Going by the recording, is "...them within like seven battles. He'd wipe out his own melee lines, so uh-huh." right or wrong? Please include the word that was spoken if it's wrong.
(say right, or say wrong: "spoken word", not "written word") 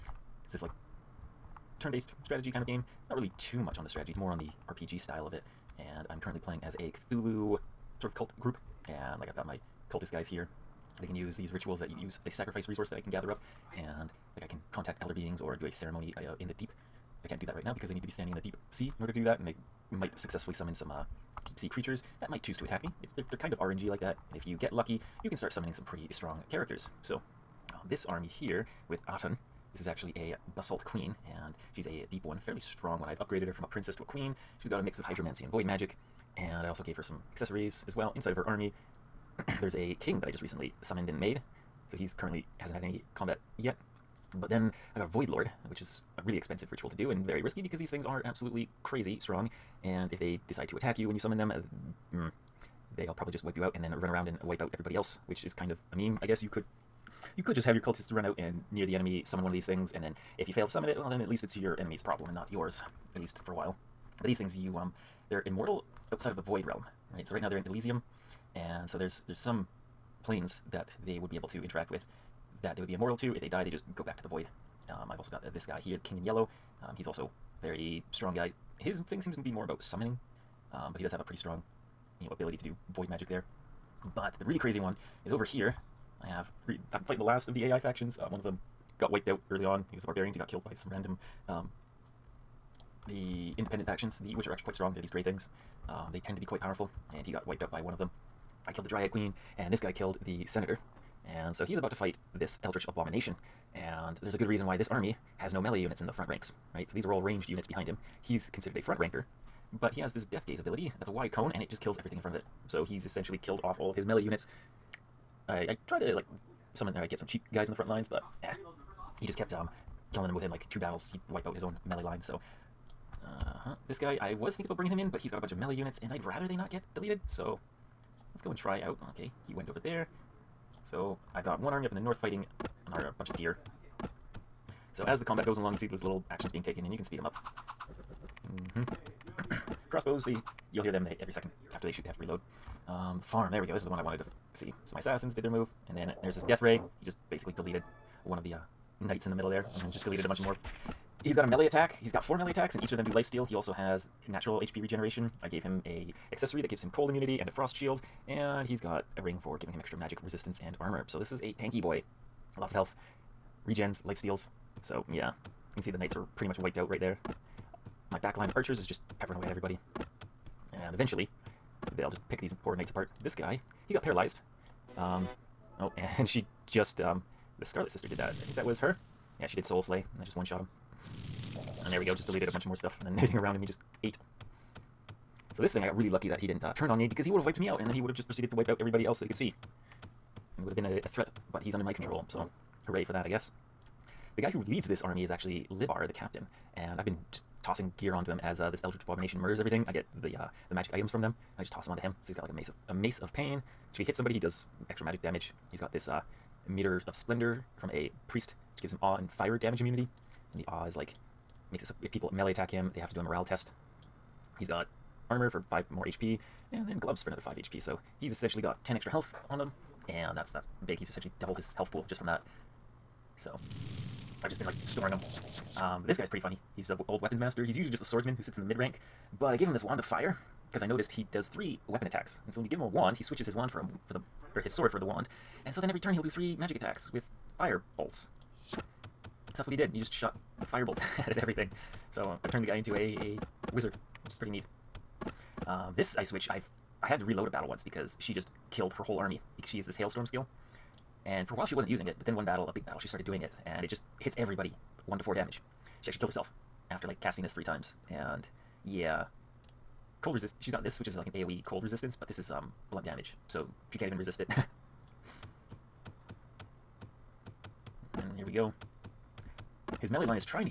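wrong: "two", not "seven".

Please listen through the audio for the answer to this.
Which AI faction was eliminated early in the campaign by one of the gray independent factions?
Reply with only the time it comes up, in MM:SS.
01:30.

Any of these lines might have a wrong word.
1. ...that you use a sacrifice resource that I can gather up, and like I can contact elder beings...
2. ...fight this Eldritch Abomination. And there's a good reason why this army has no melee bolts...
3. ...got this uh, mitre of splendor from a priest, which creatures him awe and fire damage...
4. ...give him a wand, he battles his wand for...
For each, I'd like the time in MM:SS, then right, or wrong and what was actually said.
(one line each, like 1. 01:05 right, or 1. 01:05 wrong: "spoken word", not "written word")
1. 00:11 right
2. 01:41 wrong: "units", not "bolts"
3. 03:25 wrong: "gives", not "creatures"
4. 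03:52 wrong: "switches", not "battles".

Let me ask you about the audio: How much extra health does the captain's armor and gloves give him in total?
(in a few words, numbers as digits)
10.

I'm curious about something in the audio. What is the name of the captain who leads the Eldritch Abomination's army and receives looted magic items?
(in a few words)
Libar.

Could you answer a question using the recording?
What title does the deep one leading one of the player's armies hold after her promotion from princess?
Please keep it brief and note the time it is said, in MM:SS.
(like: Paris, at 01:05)
Basalt Queen, at 00:30.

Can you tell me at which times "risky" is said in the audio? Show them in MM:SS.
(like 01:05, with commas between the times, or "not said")
00:47.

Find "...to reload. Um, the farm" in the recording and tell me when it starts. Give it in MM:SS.
02:22.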